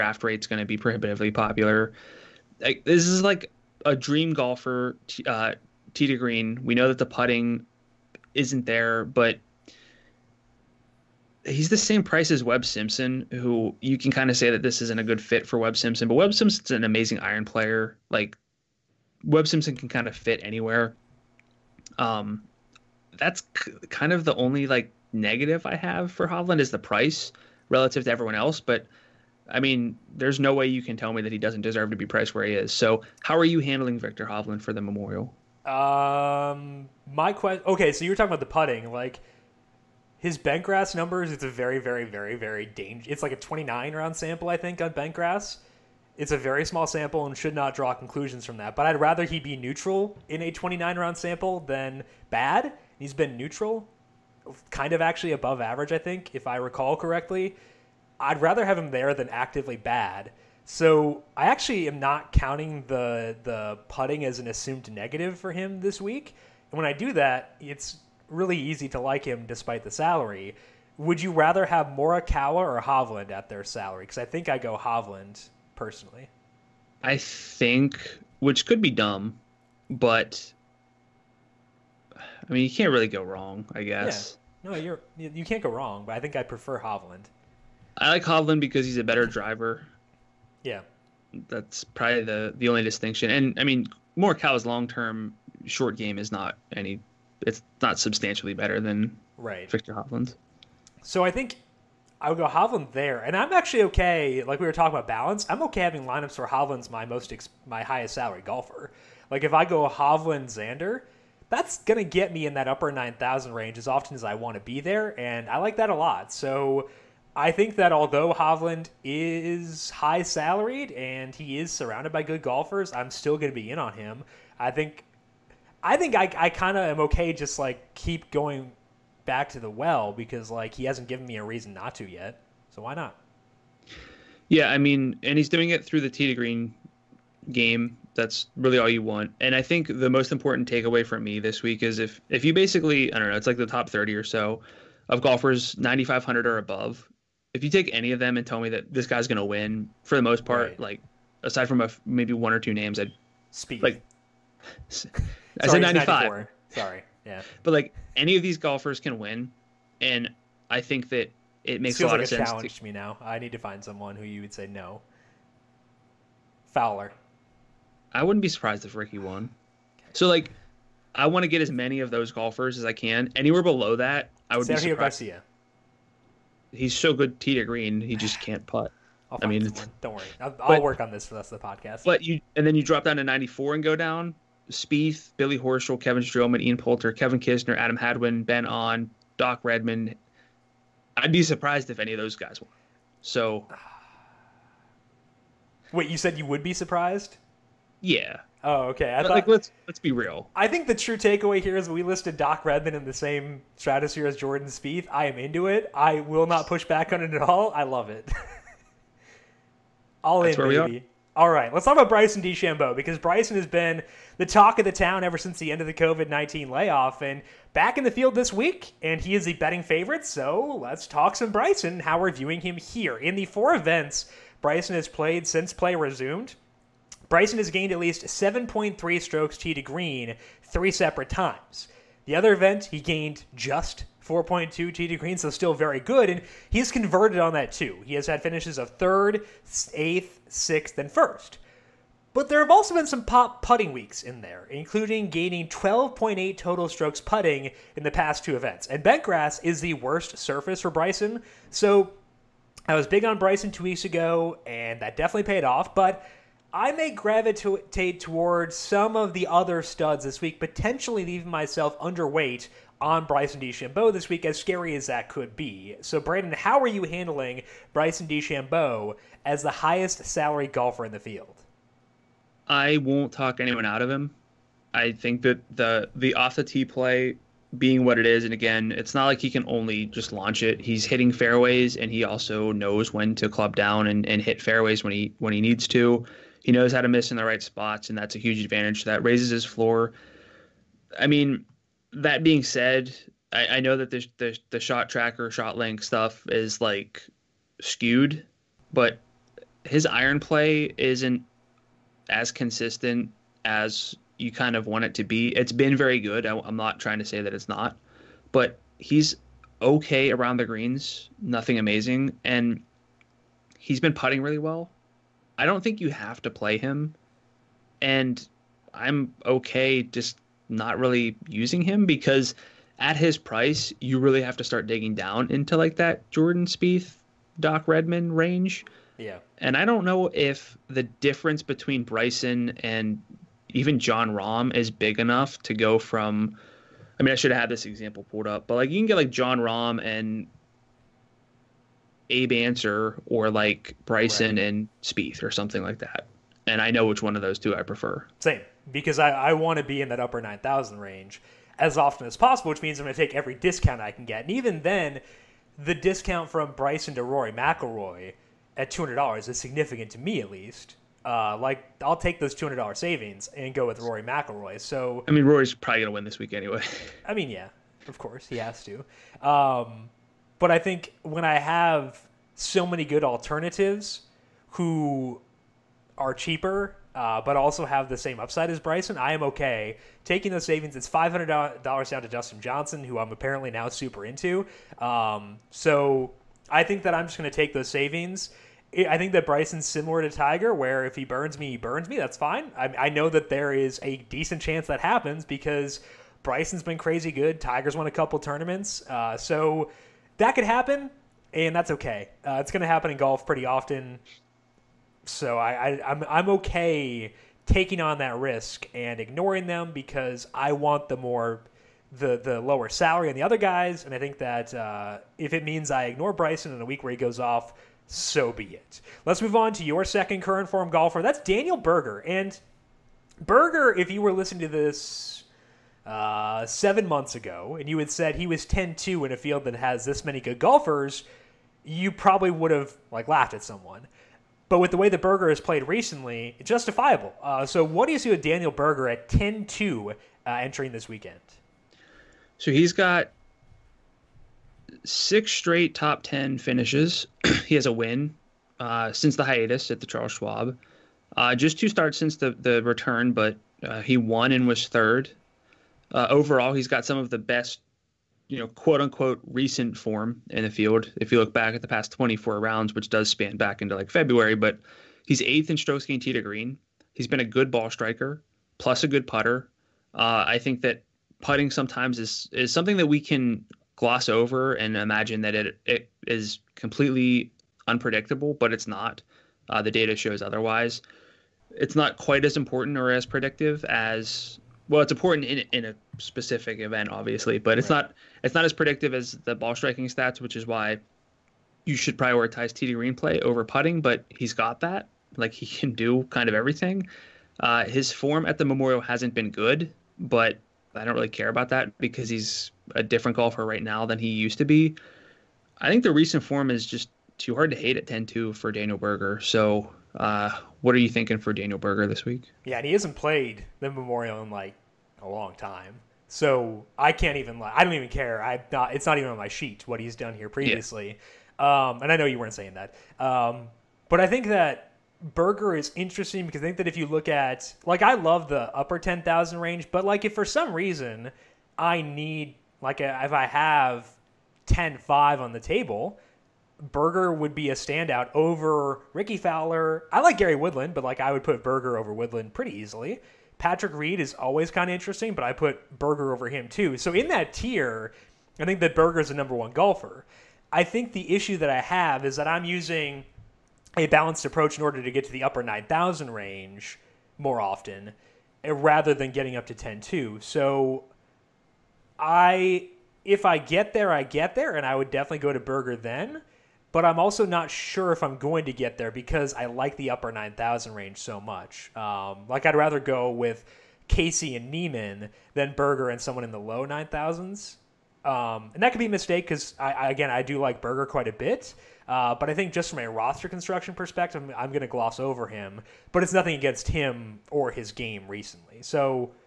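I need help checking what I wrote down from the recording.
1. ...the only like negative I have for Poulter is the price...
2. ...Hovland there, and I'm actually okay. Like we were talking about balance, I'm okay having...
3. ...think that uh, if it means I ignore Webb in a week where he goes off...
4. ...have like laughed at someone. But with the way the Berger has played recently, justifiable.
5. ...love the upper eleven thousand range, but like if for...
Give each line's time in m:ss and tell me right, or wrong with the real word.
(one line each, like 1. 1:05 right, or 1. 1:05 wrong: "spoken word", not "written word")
1. 0:24 wrong: "Hovland", not "Poulter"
2. 1:42 right
3. 6:54 wrong: "Bryson", not "Webb"
4. 7:12 right
5. 8:48 wrong: "ten", not "eleven".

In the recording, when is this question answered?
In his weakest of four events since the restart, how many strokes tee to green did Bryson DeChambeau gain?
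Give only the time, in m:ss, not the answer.
3:54.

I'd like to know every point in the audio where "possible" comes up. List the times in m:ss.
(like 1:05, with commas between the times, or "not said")
5:52.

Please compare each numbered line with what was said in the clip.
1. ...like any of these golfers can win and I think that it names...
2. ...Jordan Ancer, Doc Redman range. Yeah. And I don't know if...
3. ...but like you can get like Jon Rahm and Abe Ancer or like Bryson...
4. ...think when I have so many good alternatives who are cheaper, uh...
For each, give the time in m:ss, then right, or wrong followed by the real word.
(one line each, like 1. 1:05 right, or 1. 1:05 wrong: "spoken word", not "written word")
1. 2:37 wrong: "makes", not "names"
2. 5:26 wrong: "Spieth", not "Ancer"
3. 5:38 right
4. 6:10 right.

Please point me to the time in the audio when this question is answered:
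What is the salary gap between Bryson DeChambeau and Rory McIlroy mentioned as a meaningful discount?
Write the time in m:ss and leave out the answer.
5:58.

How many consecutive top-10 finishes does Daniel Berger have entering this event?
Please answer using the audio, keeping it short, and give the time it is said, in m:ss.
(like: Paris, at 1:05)
6, at 7:25.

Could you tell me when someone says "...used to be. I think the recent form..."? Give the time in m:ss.
8:24.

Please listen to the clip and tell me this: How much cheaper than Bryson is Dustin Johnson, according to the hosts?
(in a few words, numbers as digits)
$500.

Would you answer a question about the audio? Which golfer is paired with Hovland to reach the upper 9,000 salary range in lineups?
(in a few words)
Xander.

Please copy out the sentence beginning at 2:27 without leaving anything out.
If you take any of them and tell me that this guy's going to win for the most part, right.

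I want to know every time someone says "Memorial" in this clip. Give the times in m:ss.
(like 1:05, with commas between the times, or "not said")
0:34, 8:18, 8:33.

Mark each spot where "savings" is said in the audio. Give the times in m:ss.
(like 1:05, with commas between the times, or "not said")
6:02, 6:20, 6:27.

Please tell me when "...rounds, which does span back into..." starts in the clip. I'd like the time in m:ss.
7:42.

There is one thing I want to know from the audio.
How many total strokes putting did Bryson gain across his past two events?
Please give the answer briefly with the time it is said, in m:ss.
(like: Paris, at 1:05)
12.8, at 4:05.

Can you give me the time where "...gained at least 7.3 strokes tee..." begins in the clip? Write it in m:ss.
3:47.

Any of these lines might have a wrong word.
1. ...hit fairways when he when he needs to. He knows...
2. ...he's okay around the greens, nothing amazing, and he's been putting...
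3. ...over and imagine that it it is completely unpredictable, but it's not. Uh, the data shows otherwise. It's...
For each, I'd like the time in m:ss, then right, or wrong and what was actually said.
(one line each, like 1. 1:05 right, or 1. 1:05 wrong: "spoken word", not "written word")
1. 4:44 right
2. 5:08 right
3. 7:54 right.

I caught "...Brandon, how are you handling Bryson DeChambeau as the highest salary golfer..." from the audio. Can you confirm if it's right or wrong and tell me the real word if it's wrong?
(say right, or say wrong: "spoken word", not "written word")
right.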